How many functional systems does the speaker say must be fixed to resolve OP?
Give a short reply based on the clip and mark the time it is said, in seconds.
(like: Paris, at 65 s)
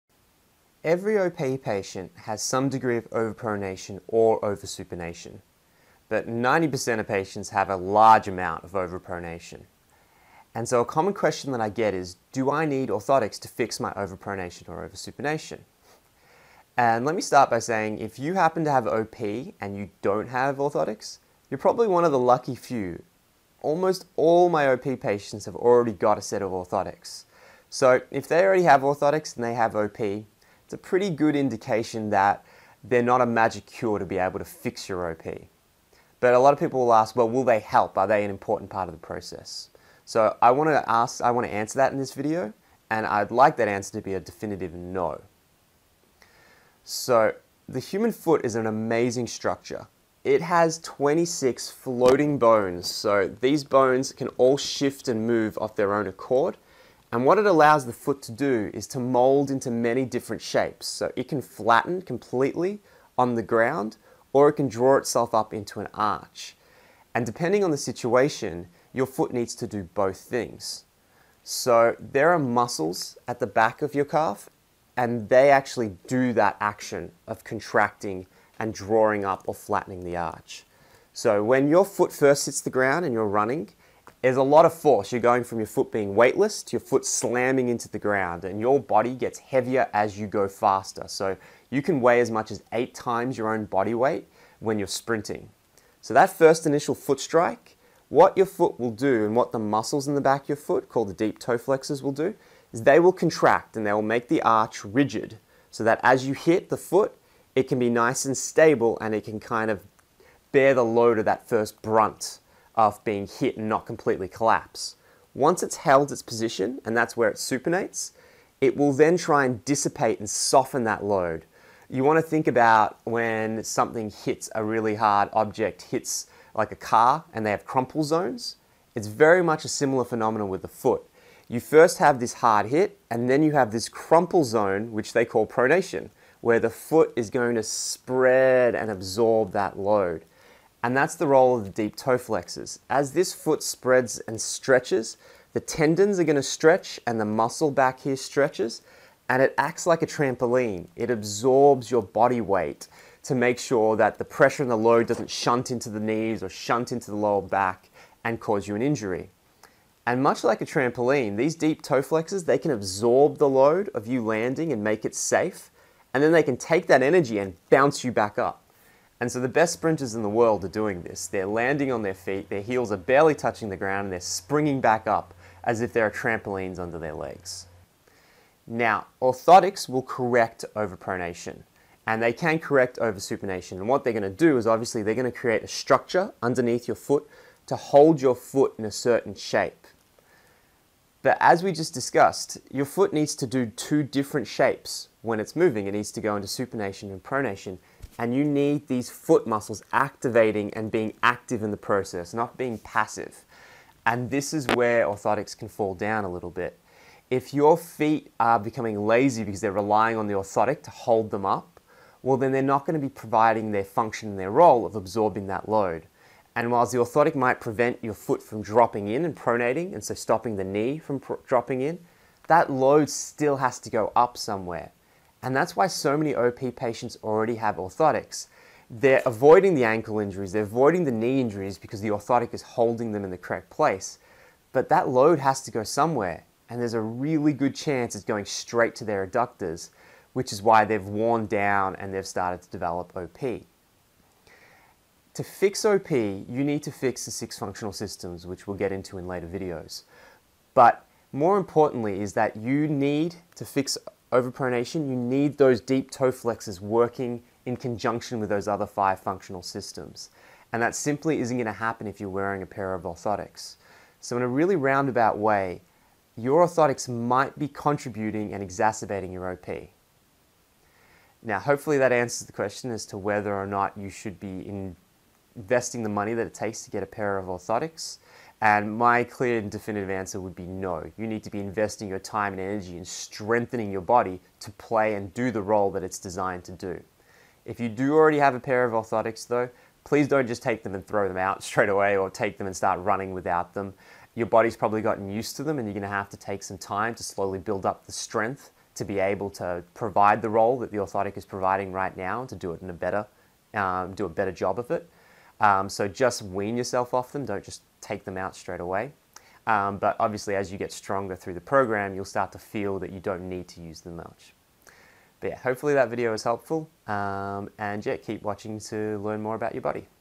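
6, at 247 s.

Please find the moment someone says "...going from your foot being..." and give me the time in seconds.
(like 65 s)
85 s.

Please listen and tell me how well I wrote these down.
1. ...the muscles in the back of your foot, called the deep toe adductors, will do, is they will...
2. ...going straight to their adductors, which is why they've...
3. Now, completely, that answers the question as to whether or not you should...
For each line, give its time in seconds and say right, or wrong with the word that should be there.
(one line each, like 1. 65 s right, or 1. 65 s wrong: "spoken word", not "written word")
1. 99 s wrong: "flexors", not "adductors"
2. 238 s right
3. 271 s wrong: "hopefully", not "completely".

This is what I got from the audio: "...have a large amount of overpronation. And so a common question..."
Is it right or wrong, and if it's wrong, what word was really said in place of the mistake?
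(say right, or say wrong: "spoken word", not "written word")
right.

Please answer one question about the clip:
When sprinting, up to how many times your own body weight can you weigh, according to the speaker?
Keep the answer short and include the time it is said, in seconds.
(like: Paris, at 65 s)
8, at 92 s.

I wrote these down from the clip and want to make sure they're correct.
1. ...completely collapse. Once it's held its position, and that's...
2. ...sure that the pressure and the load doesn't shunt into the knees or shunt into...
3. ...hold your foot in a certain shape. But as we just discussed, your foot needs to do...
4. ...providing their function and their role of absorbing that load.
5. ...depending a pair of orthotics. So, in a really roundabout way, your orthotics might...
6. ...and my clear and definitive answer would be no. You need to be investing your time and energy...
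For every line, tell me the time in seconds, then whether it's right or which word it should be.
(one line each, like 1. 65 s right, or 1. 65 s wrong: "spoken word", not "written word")
1. 113 s right
2. 153 s right
3. 187 s right
4. 213 s right
5. 262 s wrong: "wearing", not "depending"
6. 278 s right.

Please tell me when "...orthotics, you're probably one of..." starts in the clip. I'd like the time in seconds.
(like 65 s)
20 s.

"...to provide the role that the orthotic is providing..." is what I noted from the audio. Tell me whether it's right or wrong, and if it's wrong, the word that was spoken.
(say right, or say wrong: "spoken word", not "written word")
right.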